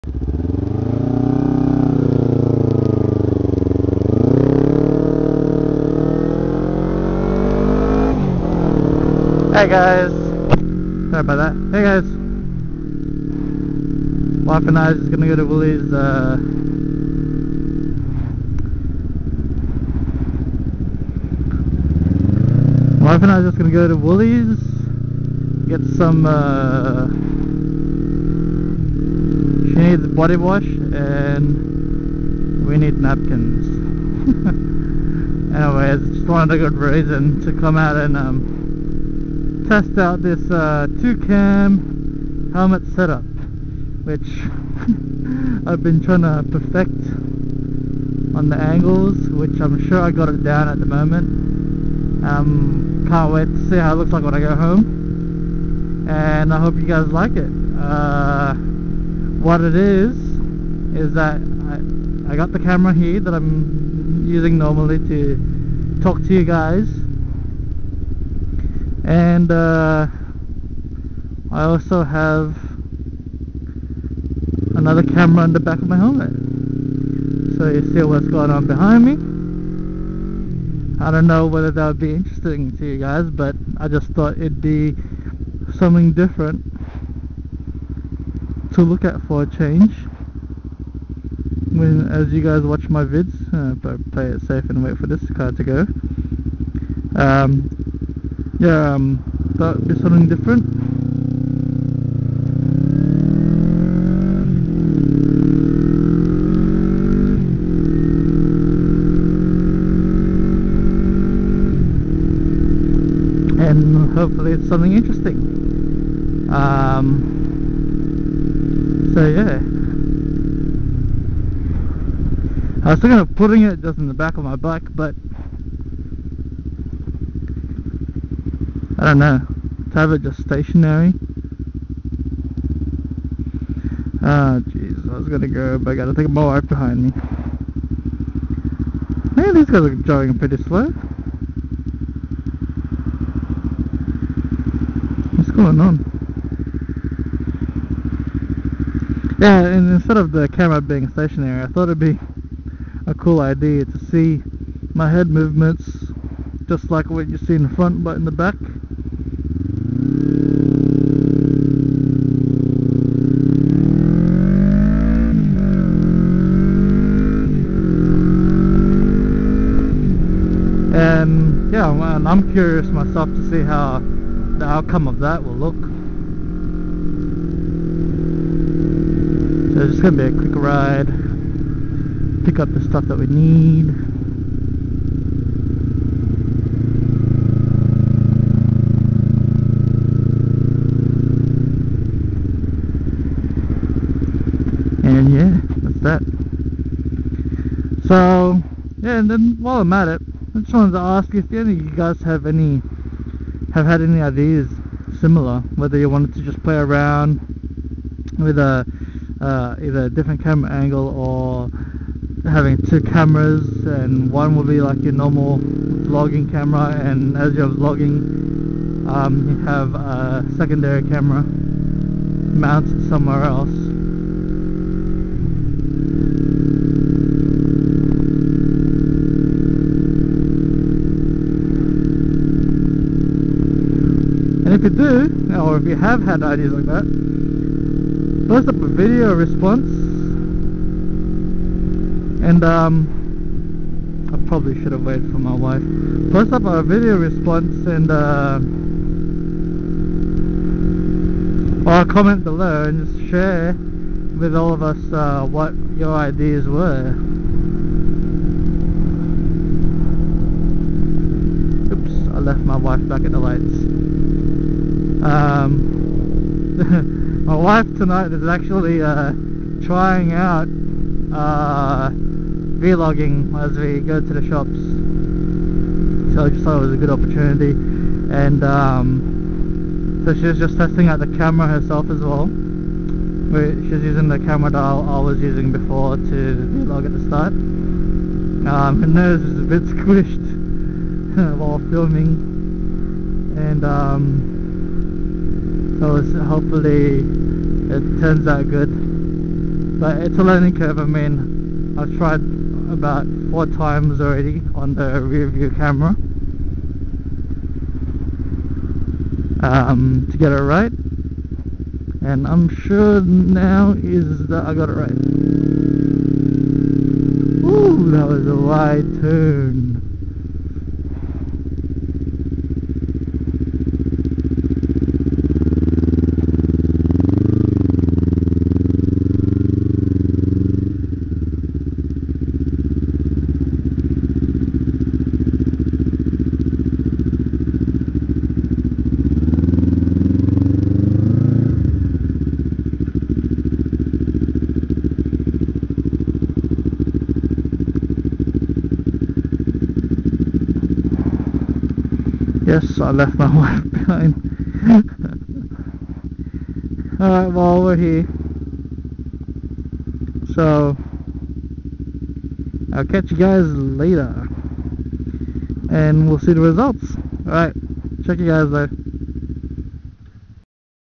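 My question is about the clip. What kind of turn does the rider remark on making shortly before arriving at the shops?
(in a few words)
wide turn.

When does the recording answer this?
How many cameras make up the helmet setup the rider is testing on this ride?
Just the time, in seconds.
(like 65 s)
40 s.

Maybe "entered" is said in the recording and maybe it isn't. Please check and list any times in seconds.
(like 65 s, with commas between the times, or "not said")
not said.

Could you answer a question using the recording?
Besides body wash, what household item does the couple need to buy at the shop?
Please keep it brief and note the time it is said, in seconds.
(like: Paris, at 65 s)
napkins, at 32 s.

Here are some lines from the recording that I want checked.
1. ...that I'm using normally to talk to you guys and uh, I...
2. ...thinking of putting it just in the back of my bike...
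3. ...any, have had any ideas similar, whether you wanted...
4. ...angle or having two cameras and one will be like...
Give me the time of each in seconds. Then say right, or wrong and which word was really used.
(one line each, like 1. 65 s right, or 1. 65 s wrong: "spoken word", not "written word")
1. 63 s right
2. 123 s right
3. 202 s right
4. 210 s right.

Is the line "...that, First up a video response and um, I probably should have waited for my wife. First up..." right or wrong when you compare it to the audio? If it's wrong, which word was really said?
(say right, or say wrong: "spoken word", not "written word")
right.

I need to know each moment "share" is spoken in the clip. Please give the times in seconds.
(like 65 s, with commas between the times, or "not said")
253 s.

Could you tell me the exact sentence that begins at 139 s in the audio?
Man, these guys are driving pretty slow.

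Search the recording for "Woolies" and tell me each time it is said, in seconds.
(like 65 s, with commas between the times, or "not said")
15 s, 23 s.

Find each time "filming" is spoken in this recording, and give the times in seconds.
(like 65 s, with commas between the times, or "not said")
291 s.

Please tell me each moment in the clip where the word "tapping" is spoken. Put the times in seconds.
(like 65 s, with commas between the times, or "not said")
not said.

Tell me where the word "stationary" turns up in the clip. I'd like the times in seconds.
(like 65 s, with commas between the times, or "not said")
130 s, 151 s.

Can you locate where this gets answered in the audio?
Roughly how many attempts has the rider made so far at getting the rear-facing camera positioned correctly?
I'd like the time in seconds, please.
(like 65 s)
303 s.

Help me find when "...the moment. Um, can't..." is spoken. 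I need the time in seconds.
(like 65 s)
50 s.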